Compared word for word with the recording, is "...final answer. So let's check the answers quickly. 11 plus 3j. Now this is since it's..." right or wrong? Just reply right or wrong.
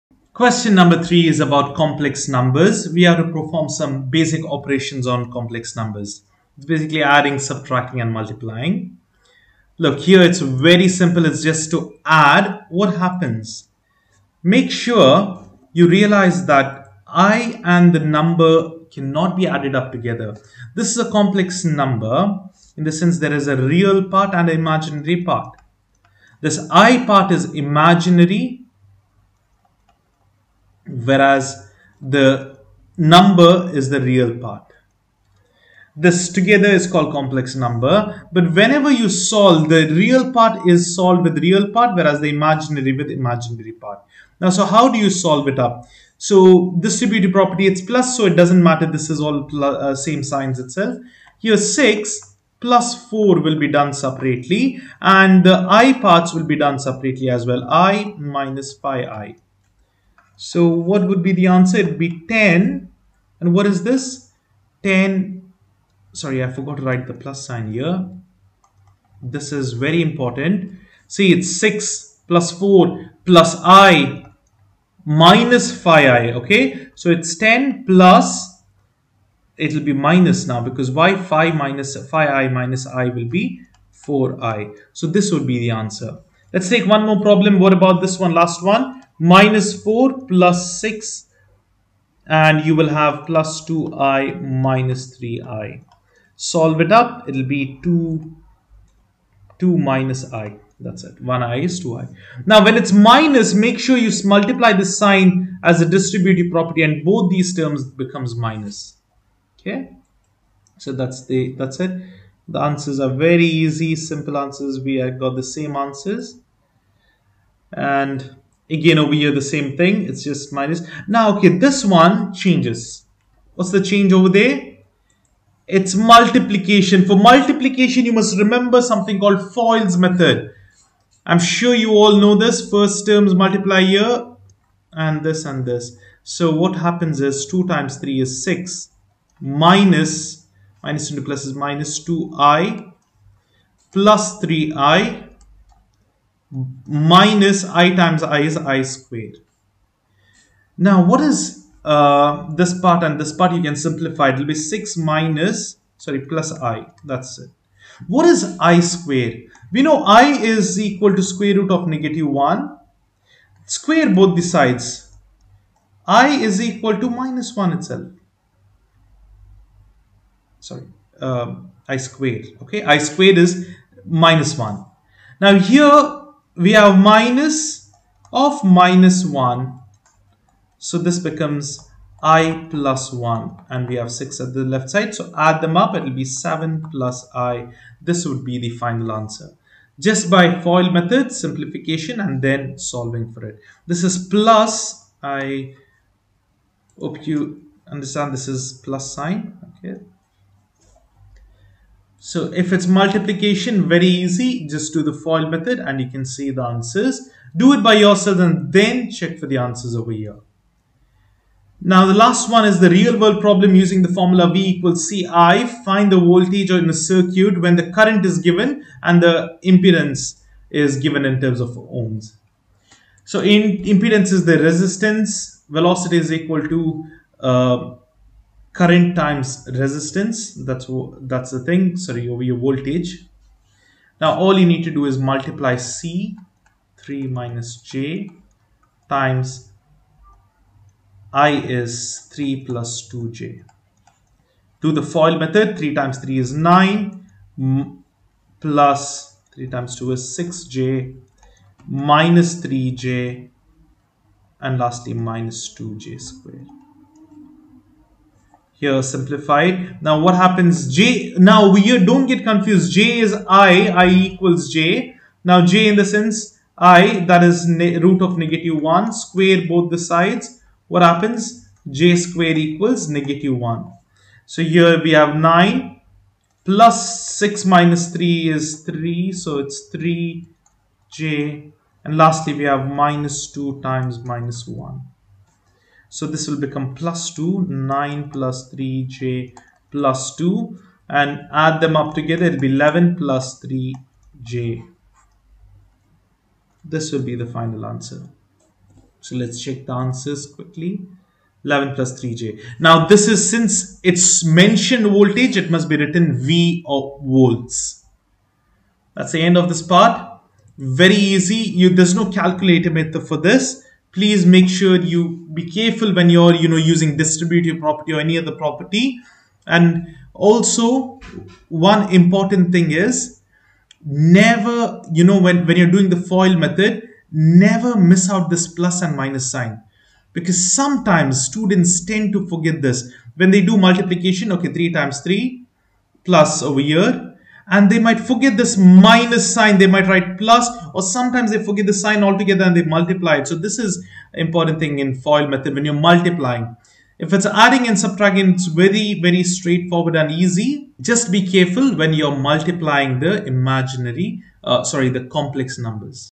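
right.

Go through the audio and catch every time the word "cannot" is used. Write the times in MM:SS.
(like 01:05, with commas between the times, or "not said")
00:18.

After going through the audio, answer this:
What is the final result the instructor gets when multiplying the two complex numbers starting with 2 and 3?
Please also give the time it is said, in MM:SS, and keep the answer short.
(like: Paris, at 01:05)
7 + i, at 03:06.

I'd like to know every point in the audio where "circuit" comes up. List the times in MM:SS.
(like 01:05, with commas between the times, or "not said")
03:36.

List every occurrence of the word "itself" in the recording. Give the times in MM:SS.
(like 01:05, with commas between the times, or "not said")
00:50, 02:47.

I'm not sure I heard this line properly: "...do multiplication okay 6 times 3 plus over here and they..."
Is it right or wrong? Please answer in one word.
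wrong.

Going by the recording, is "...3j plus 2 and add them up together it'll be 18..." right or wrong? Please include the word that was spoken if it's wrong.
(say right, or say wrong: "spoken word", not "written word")
wrong: "11", not "18".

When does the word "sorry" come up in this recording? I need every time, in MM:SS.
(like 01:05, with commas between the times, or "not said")
01:06, 02:35, 02:50, 03:52, 05:54.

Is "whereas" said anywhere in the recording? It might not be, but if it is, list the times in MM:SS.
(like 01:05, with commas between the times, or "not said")
00:30, 00:41.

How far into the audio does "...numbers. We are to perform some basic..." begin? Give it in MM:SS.
00:02.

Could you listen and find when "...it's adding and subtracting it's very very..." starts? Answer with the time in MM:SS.
05:47.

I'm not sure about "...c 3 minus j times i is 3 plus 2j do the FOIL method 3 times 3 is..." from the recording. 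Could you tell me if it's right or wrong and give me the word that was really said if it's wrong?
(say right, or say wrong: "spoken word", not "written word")
right.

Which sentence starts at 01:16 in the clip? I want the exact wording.
Okay, so it's 10 plus, it'll be minus now because y 5 minus 5i minus i will be 4i.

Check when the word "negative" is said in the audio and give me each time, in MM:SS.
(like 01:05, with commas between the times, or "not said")
02:41, 04:28, 04:33.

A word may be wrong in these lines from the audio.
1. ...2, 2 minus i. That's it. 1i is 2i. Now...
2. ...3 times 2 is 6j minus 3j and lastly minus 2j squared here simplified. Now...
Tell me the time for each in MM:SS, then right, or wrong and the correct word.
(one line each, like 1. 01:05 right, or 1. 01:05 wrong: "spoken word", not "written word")
1. 01:37 right
2. 04:09 right.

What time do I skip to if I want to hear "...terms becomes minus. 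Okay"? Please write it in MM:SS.
01:47.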